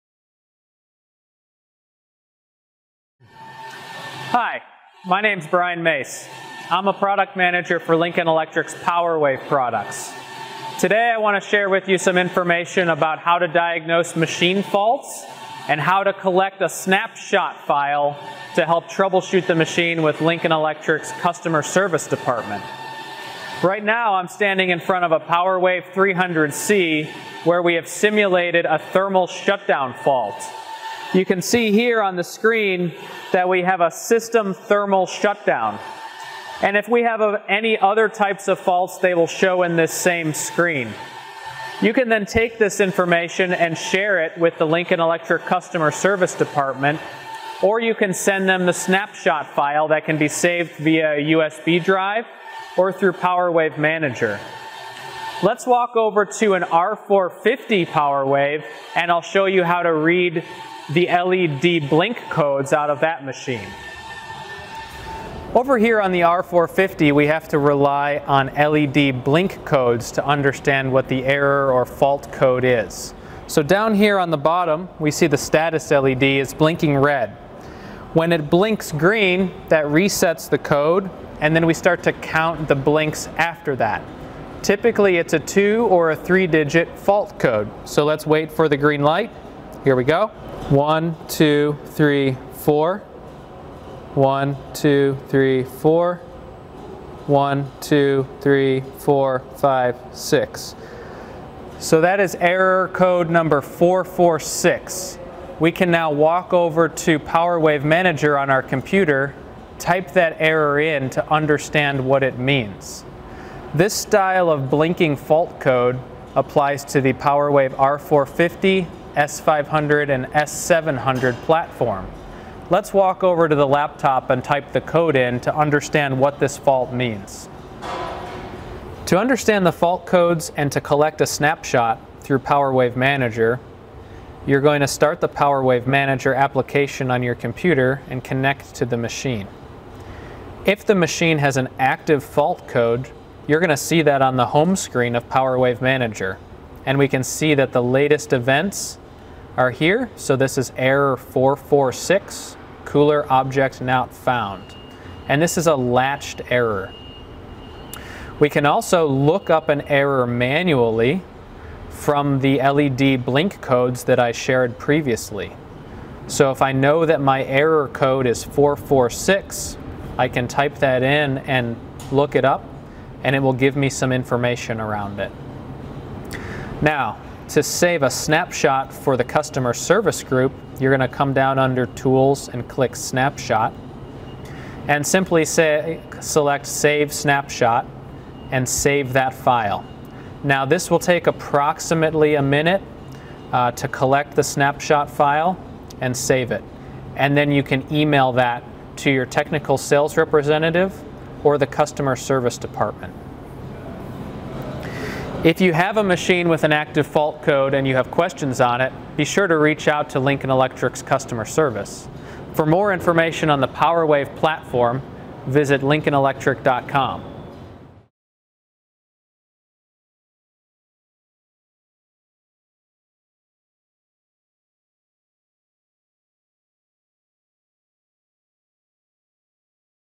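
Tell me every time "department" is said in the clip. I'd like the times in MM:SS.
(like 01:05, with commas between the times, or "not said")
00:22, 00:46, 03:22.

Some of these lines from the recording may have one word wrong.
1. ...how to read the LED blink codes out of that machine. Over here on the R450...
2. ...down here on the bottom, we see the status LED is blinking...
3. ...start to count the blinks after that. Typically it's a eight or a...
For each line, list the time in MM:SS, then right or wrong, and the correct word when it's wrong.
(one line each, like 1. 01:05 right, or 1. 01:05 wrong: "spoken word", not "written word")
1. 00:59 right
2. 01:13 right
3. 01:21 wrong: "two", not "eight".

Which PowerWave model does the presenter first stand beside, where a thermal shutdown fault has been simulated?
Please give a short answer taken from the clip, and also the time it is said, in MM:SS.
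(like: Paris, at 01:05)
PowerWave 300C, at 00:25.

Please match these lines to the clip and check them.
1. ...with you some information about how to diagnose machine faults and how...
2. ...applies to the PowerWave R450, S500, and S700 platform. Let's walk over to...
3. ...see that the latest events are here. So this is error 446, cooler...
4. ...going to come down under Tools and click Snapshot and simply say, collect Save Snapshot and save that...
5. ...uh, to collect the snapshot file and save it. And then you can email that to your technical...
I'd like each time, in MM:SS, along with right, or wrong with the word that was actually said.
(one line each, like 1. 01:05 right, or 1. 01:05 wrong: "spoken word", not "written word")
1. 00:11 right
2. 01:56 right
3. 02:27 right
4. 03:00 wrong: "select", not "collect"
5. 03:13 right.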